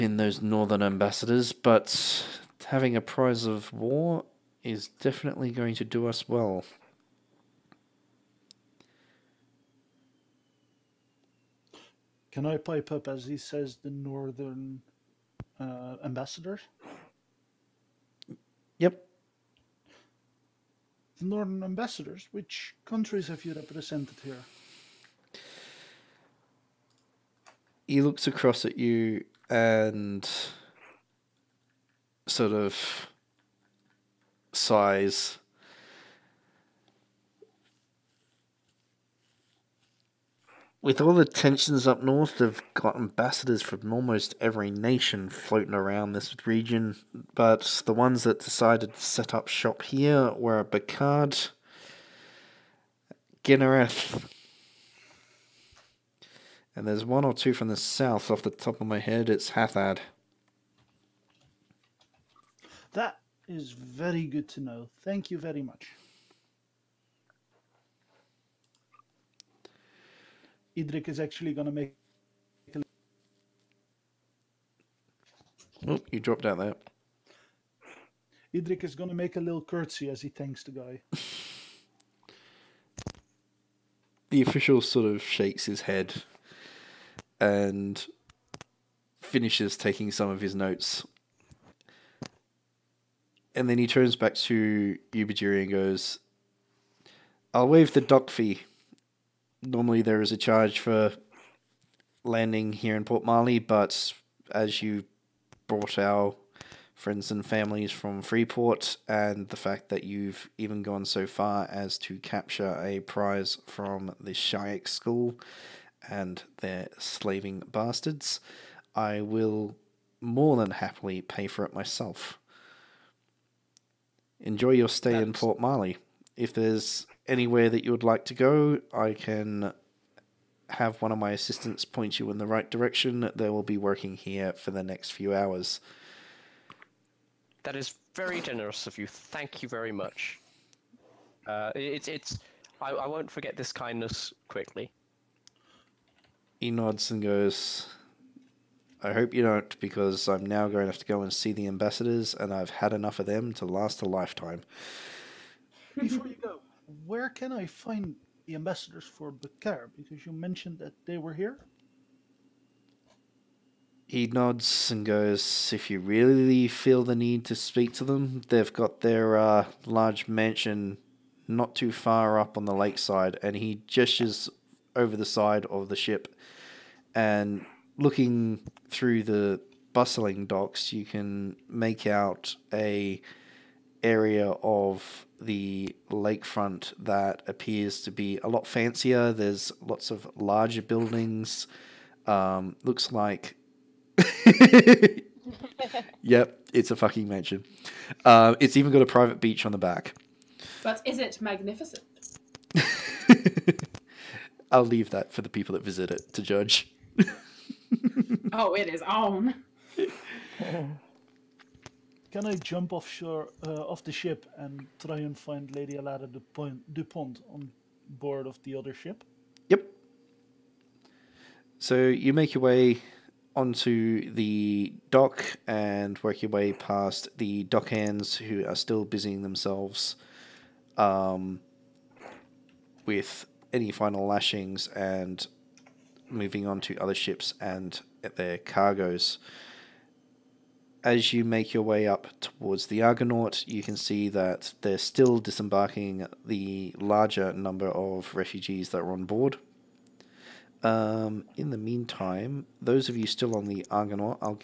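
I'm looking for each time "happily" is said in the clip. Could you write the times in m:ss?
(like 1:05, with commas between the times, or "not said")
2:00.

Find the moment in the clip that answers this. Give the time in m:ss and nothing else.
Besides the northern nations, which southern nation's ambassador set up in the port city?
0:59.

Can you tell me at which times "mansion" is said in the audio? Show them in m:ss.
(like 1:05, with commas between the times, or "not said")
2:50, 3:17.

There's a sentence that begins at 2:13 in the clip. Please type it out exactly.
They will be working here for the next few hours.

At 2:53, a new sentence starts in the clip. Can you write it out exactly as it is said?
And he gestures over the side of the ship.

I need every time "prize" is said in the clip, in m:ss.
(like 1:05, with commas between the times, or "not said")
0:02, 1:52.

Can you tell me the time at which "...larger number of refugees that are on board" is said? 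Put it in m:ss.
4:06.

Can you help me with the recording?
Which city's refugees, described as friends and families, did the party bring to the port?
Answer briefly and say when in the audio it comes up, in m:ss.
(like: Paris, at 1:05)
Freeport, at 1:48.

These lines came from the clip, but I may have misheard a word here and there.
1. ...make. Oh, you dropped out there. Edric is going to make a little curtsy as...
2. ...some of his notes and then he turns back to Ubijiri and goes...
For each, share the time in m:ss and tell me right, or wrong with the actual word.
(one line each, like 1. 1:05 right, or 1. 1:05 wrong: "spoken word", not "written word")
1. 1:11 right
2. 1:30 right.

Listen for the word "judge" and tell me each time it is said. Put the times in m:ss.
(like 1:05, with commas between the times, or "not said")
3:26.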